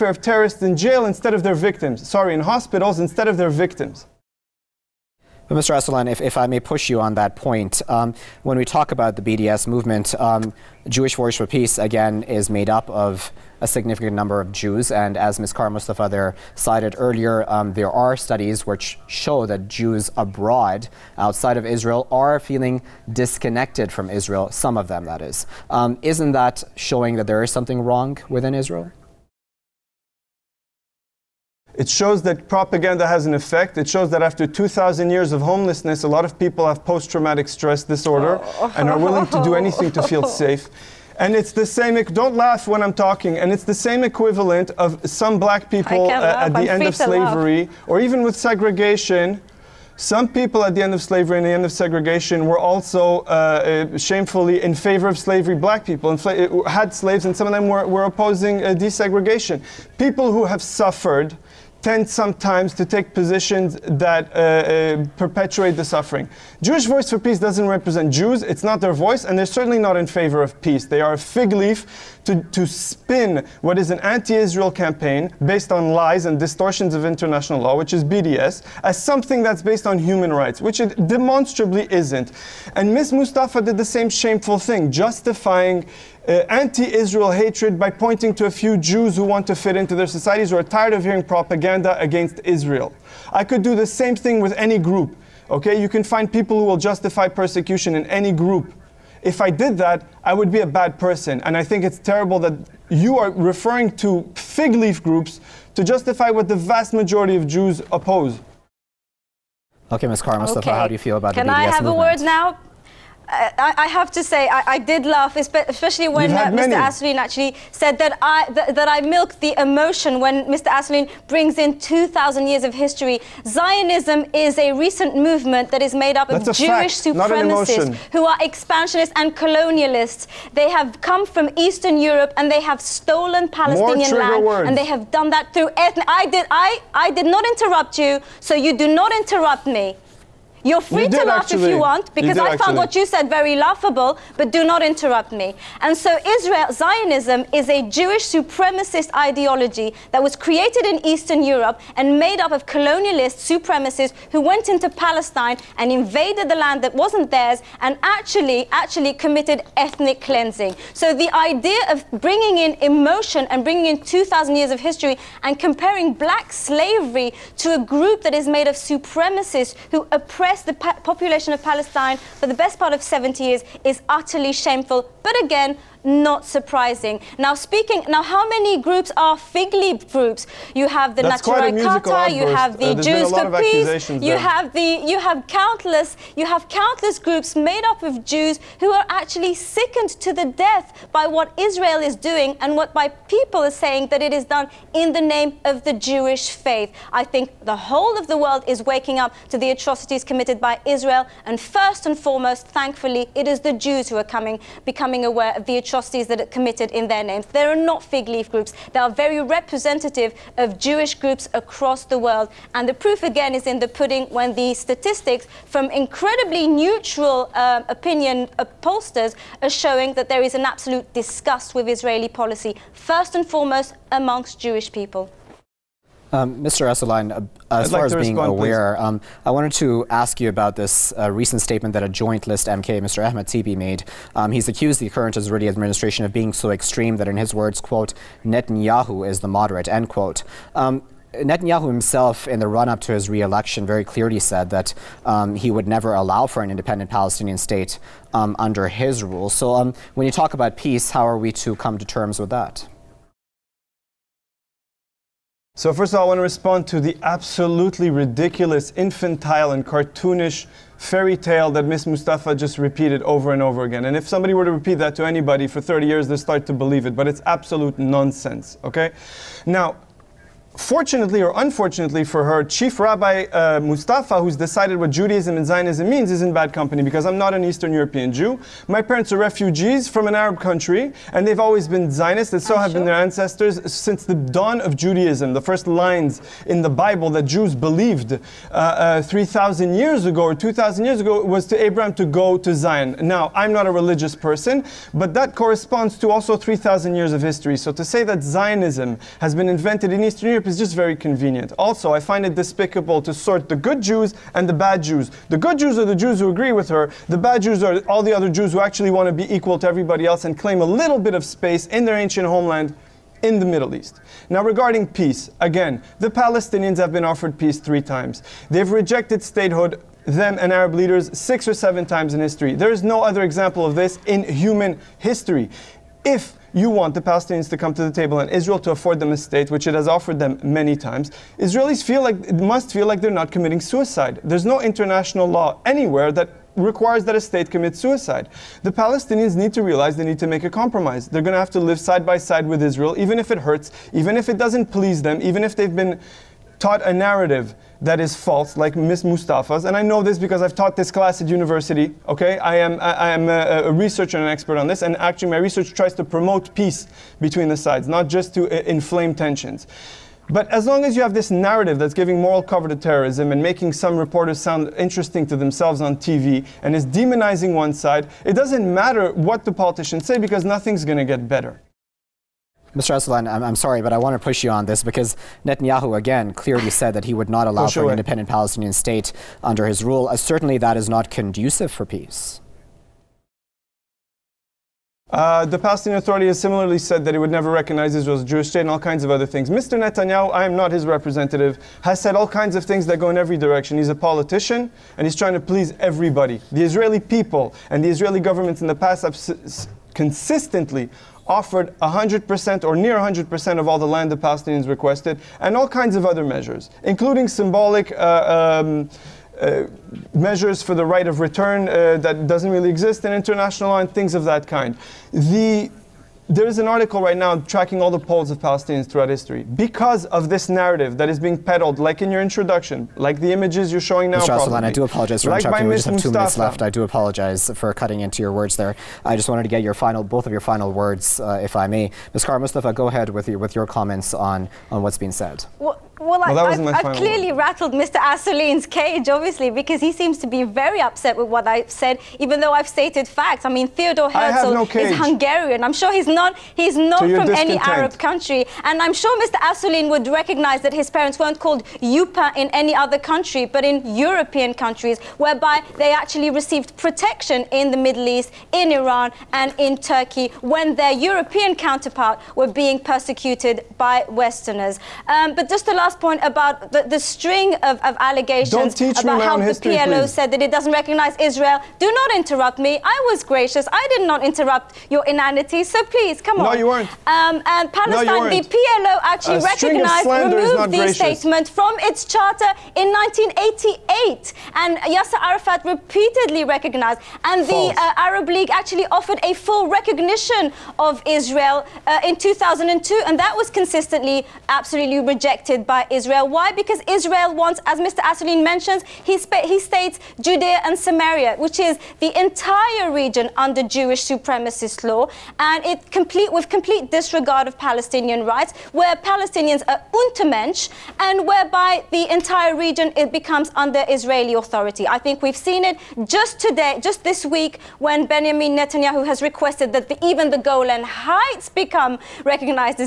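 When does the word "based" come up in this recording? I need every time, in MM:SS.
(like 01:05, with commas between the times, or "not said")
01:15, 01:19.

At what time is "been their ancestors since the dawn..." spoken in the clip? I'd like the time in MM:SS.
04:42.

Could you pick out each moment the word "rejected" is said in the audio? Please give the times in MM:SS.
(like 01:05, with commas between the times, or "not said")
05:18, 08:15.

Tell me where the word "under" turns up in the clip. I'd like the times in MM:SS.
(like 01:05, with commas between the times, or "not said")
04:08, 06:19, 08:23, 08:33.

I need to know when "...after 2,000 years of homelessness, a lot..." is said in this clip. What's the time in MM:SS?
00:34.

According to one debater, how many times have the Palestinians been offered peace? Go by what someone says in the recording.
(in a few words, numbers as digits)
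3.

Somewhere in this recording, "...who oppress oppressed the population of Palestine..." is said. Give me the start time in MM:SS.
02:49.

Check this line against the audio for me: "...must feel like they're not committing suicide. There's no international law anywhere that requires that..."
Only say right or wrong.
right.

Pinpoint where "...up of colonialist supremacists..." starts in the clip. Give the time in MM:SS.
02:32.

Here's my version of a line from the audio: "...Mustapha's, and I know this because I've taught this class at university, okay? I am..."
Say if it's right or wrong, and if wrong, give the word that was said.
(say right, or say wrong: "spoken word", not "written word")
right.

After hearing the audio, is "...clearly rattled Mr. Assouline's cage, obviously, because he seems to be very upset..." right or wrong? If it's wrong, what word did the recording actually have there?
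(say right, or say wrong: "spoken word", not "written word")
right.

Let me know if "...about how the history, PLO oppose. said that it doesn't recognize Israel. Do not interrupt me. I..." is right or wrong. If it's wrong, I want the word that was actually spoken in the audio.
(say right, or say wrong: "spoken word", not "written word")
wrong: "please", not "oppose".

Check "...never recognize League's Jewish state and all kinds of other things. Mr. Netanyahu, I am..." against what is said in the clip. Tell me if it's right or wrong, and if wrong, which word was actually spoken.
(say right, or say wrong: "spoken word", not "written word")
wrong: "Israel", not "League".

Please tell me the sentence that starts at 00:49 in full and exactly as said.
Some people at the end of slavery and the end of segregation were also uh, uh shamefully in favor of slavery.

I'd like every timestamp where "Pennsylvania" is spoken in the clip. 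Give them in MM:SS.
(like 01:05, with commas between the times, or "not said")
not said.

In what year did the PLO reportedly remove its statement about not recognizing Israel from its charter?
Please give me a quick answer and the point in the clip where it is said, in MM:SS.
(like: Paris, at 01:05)
1988, at 08:03.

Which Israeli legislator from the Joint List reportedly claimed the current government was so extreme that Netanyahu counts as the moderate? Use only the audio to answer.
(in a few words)
Ahmed Tibi.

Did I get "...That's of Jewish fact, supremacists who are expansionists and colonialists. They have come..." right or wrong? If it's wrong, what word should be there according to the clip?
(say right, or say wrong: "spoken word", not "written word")
right.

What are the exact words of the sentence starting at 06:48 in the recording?
Uh, um, uh, measures for the right of return uh, that doesn't really exist in international law and things of that kind.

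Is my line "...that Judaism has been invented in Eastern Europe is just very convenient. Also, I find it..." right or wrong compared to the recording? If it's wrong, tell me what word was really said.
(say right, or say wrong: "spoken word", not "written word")
wrong: "Zionism", not "Judaism".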